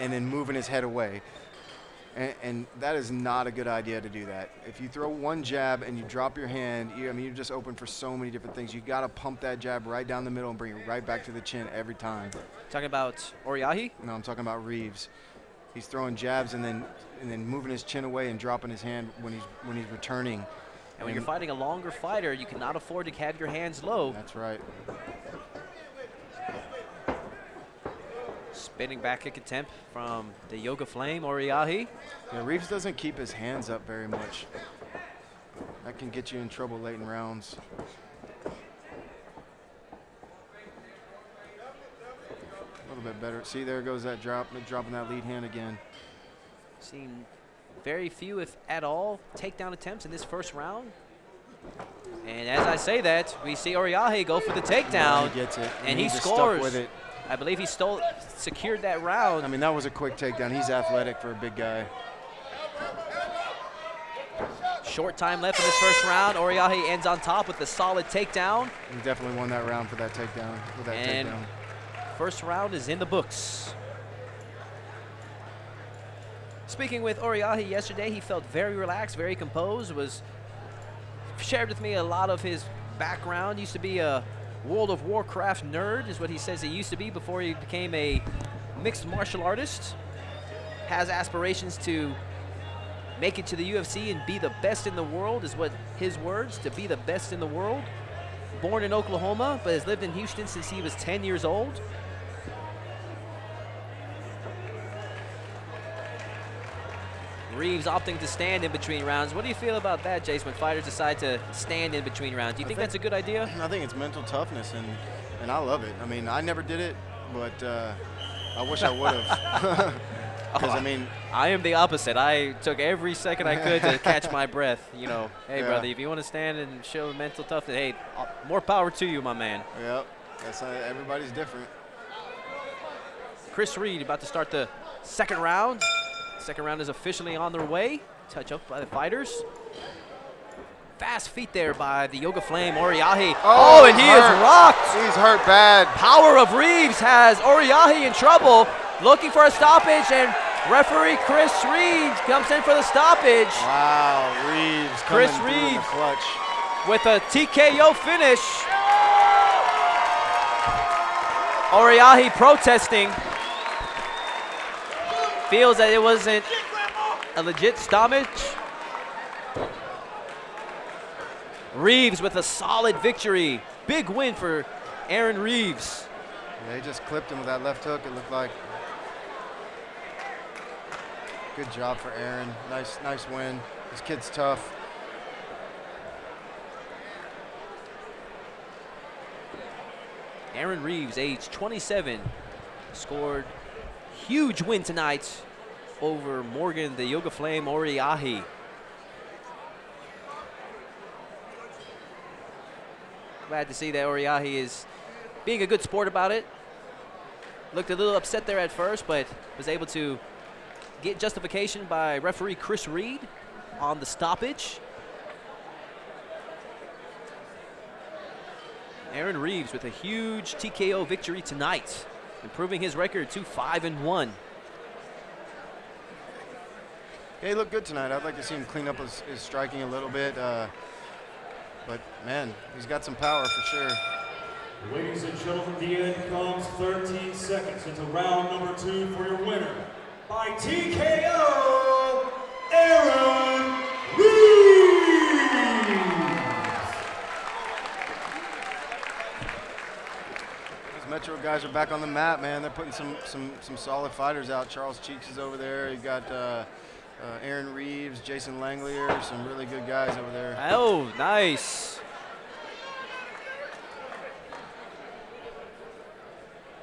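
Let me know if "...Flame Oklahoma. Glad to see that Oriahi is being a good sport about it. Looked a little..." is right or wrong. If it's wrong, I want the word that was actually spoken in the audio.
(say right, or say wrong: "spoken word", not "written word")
wrong: "Oriahi", not "Oklahoma".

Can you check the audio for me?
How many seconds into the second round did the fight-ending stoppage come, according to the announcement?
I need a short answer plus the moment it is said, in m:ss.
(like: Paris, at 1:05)
13, at 3:56.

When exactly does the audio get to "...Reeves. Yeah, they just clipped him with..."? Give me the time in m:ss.
2:55.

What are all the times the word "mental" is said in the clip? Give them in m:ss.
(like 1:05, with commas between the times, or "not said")
1:53, 2:07.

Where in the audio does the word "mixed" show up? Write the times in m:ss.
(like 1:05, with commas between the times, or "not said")
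1:28.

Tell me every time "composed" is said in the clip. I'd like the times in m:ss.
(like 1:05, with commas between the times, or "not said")
1:19.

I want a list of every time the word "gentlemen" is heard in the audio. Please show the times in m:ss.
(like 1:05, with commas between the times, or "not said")
3:55.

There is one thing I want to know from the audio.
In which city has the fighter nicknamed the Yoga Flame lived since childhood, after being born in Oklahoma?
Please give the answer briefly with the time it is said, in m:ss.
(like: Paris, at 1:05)
Houston, at 1:40.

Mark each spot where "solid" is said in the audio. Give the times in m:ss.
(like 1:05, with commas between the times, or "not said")
1:07, 2:52, 4:13.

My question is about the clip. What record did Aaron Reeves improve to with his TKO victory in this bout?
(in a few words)
5 and 1.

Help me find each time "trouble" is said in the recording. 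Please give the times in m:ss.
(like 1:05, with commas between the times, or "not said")
0:36, 2:28.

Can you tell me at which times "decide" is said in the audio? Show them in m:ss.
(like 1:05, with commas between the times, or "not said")
1:50.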